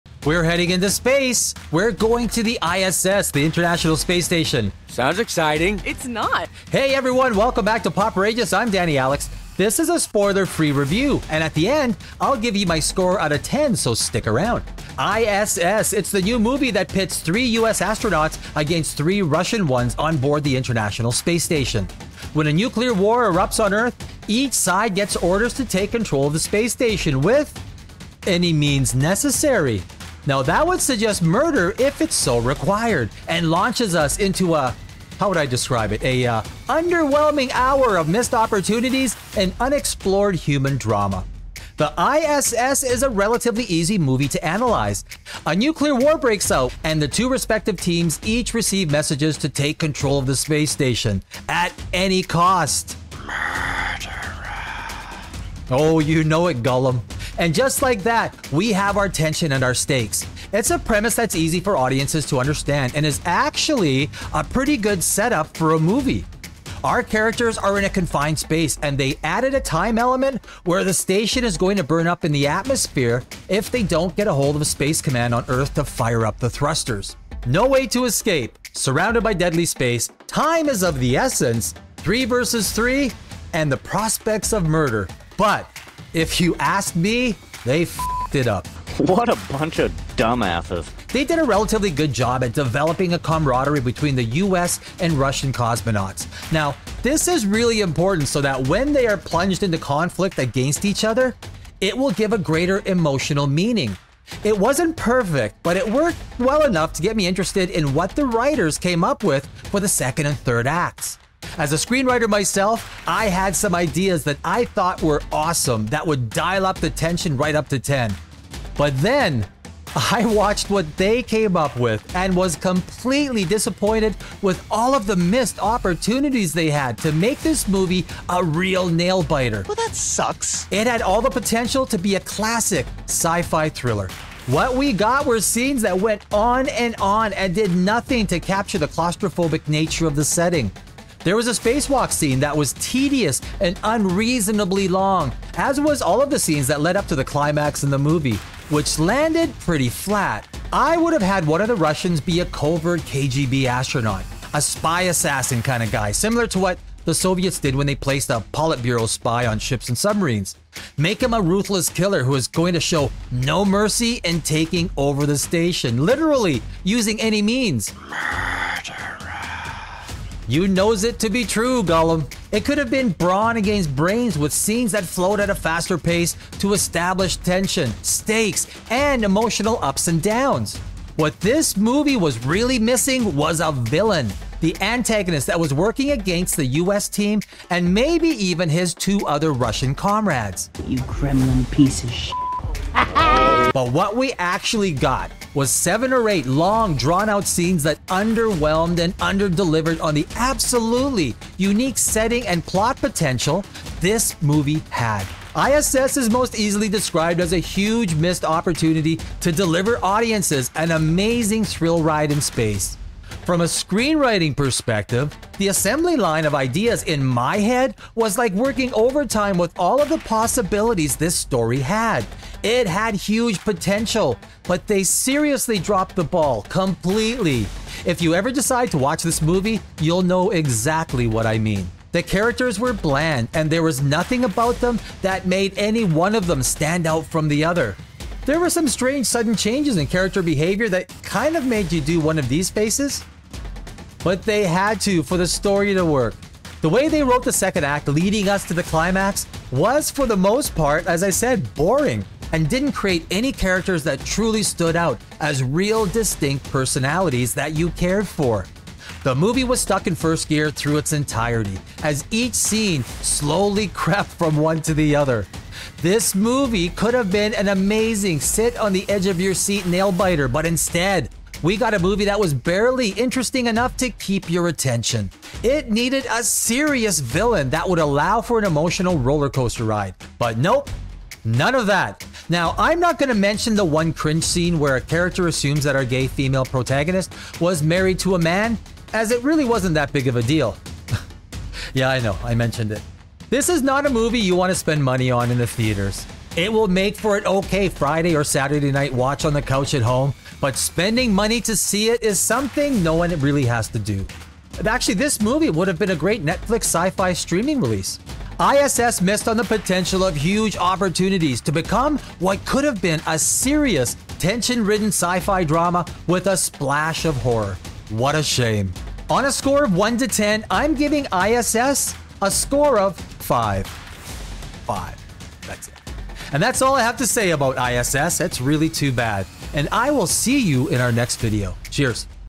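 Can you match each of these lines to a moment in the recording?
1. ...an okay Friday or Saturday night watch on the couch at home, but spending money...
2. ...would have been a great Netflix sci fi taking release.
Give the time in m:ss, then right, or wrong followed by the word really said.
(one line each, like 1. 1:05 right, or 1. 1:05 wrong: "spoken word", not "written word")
1. 4:57 right
2. 5:05 wrong: "streaming", not "taking".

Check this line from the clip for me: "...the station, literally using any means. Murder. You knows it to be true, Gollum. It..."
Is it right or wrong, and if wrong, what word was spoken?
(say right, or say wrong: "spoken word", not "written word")
right.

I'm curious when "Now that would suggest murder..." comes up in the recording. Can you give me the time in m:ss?
0:30.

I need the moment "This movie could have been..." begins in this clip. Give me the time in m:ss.
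4:26.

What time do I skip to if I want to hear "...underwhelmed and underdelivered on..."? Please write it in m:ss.
3:18.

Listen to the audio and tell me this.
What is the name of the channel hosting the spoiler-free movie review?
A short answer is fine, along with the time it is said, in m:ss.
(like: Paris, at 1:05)
Poprageous, at 0:07.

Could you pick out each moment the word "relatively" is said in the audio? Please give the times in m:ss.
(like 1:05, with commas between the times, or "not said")
0:43, 1:31.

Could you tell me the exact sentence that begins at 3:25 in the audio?
ISS is most easily described as a huge missed opportunity to deliver audiences an amazing thrill ride in space.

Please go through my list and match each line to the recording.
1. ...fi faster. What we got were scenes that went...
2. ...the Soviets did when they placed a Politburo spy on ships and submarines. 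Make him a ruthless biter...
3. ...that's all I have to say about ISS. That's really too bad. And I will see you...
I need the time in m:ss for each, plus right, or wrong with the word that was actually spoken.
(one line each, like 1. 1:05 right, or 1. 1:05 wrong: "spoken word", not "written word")
1. 2:13 wrong: "thriller", not "faster"
2. 2:37 wrong: "killer", not "biter"
3. 5:26 right.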